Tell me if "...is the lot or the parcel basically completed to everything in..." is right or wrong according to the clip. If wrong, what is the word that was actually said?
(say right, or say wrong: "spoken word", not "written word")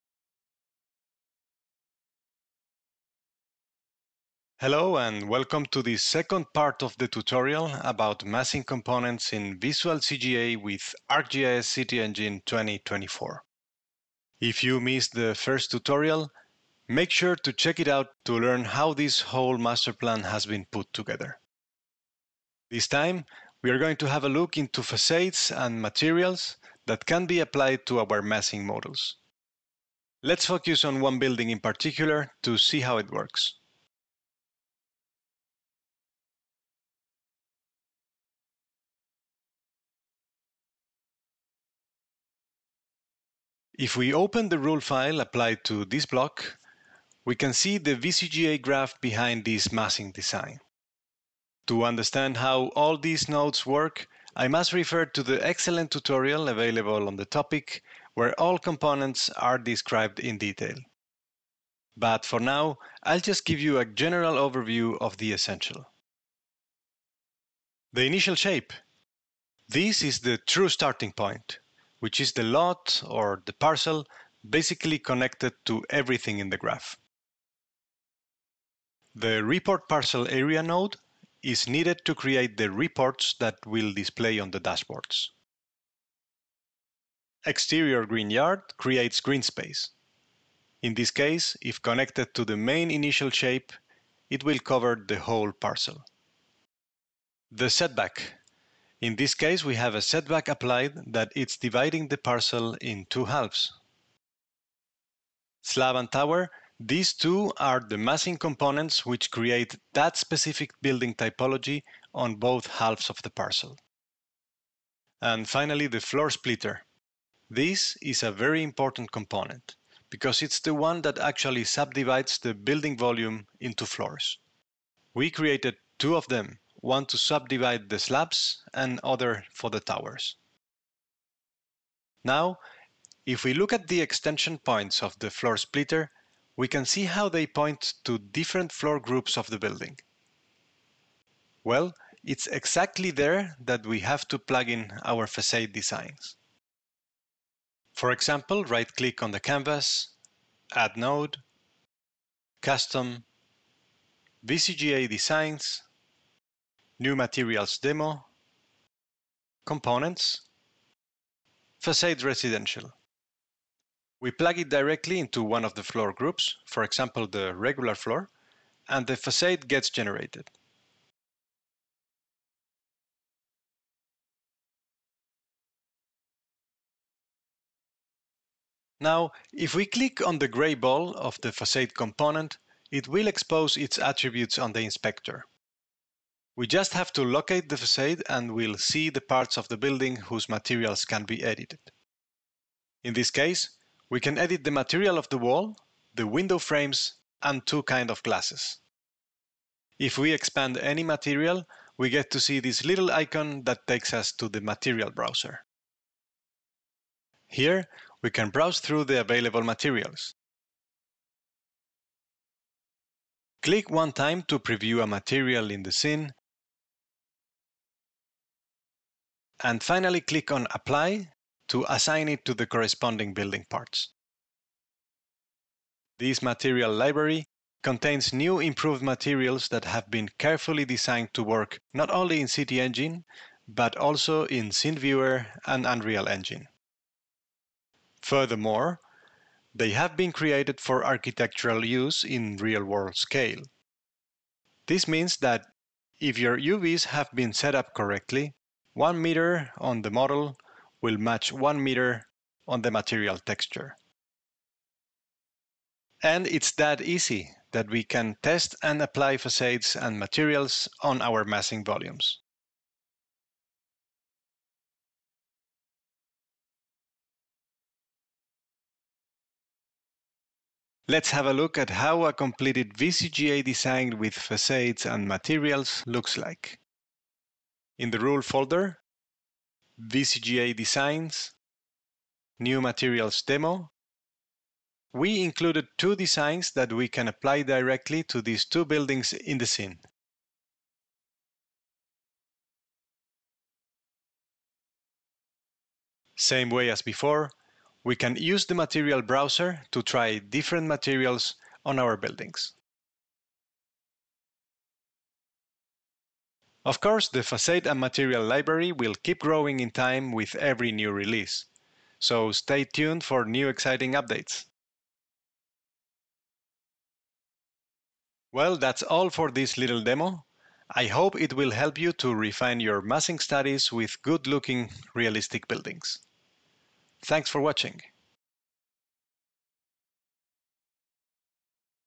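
wrong: "connected", not "completed".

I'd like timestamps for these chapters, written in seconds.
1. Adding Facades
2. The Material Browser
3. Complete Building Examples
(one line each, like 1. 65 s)
1. 36 s
2. 174 s
3. 266 s.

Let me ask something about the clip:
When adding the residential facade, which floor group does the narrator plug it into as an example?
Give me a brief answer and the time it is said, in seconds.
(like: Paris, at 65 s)
the regular floor, at 167 s.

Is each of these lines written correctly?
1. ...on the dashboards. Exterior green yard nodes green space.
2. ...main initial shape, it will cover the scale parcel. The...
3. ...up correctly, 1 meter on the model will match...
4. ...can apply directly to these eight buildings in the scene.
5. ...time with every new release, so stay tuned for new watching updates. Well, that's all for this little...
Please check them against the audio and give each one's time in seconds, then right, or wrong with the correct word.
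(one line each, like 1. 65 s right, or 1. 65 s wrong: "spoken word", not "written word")
1. 84 s wrong: "creates", not "nodes"
2. 92 s wrong: "whole", not "scale"
3. 247 s right
4. 287 s wrong: "two", not "eight"
5. 309 s wrong: "exciting", not "watching".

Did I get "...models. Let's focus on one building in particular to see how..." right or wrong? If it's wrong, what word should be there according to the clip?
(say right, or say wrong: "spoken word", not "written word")
right.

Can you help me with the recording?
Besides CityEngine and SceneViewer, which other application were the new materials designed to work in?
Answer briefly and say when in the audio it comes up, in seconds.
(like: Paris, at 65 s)
Unreal Engine, at 235 s.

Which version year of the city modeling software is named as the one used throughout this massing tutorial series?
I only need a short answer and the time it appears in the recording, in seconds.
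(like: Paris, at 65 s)
2024, at 12 s.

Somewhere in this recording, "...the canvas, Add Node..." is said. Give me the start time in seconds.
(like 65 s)
149 s.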